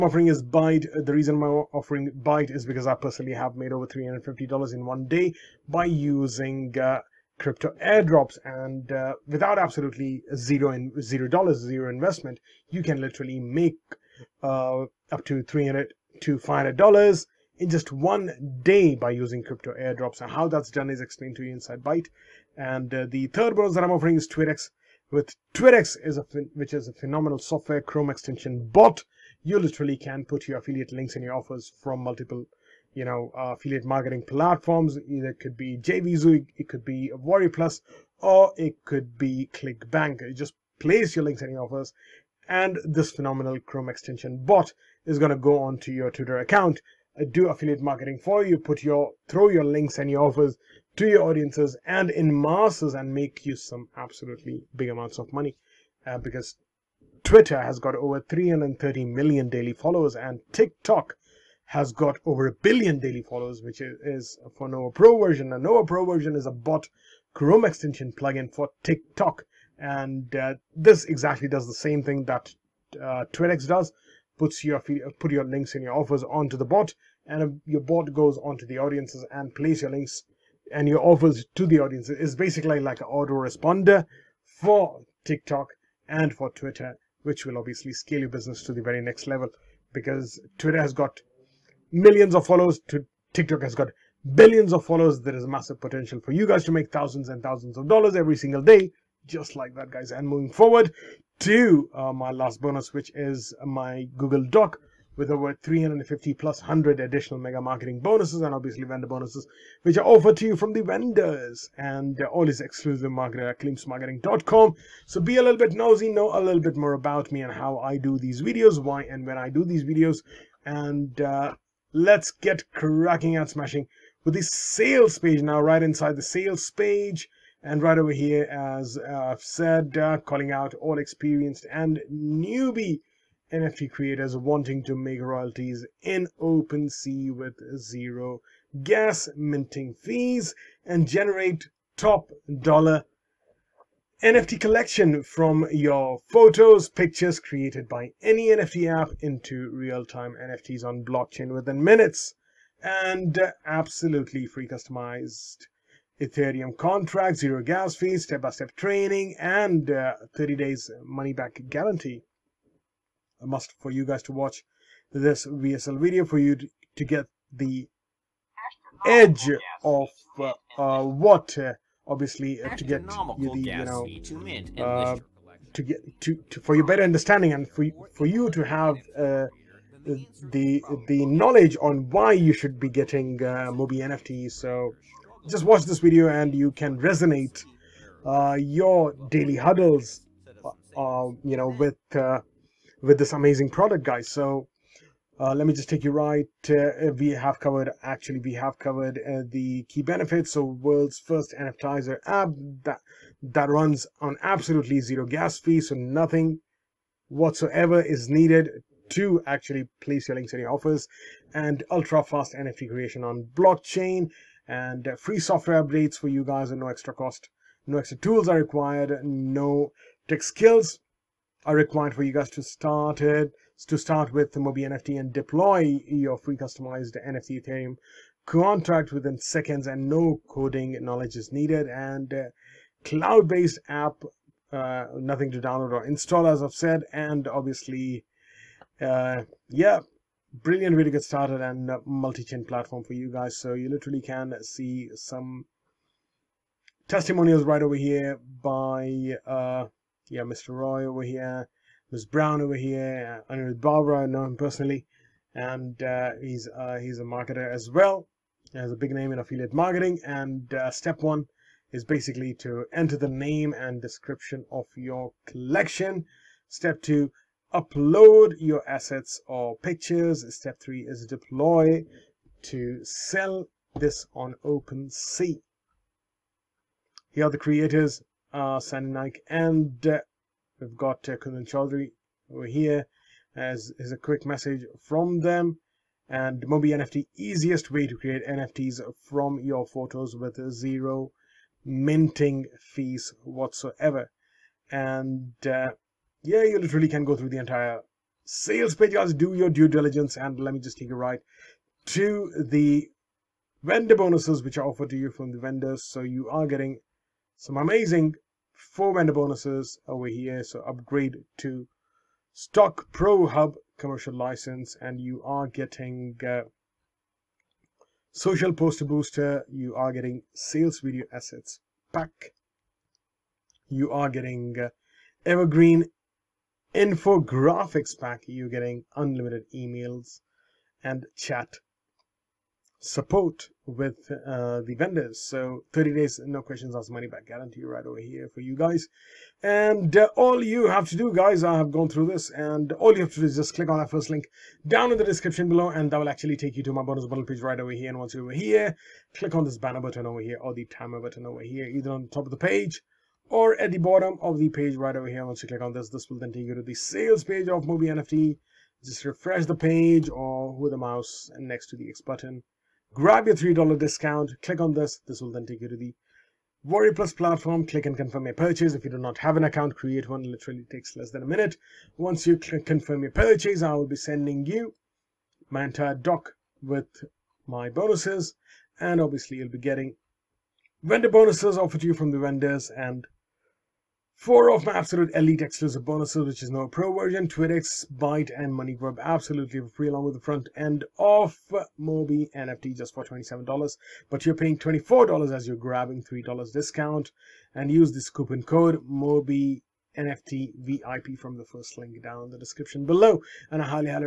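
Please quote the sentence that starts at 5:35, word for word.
So 30 days, no questions asked, money back guarantee right over here for you guys.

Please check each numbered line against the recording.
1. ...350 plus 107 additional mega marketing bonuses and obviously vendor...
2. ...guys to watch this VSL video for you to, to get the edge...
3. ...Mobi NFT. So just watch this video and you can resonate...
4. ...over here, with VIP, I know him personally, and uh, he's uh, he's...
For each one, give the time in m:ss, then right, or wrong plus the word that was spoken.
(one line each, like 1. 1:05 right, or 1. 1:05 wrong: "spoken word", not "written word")
1. 1:45 wrong: "100", not "107"
2. 2:44 right
3. 3:03 right
4. 4:12 wrong: "Barbara", not "VIP".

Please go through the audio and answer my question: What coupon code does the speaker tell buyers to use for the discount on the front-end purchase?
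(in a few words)
MOBI NFT VIP.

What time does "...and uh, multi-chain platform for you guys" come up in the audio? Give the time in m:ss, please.
4:01.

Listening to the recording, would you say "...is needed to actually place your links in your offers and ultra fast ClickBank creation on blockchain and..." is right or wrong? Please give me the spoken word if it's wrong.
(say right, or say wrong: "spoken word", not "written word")
wrong: "NFT", not "ClickBank".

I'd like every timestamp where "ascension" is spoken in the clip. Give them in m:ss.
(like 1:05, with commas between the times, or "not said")
not said.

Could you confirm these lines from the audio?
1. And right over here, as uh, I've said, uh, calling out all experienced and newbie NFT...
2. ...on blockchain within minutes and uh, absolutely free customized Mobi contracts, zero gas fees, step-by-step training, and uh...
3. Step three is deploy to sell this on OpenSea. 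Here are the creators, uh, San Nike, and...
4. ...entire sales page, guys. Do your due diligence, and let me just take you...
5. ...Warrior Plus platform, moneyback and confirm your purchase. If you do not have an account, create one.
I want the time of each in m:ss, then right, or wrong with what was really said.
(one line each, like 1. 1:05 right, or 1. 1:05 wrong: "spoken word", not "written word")
1. 2:07 right
2. 2:30 wrong: "Ethereum", not "Mobi"
3. 4:30 right
4. 4:57 right
5. 6:06 wrong: "click", not "moneyback".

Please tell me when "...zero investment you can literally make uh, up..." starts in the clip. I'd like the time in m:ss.
0:11.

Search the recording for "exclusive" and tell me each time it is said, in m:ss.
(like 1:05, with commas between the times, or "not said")
1:52, 6:25.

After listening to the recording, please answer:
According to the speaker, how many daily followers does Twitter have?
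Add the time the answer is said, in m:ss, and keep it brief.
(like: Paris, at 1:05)
330 million, at 0:58.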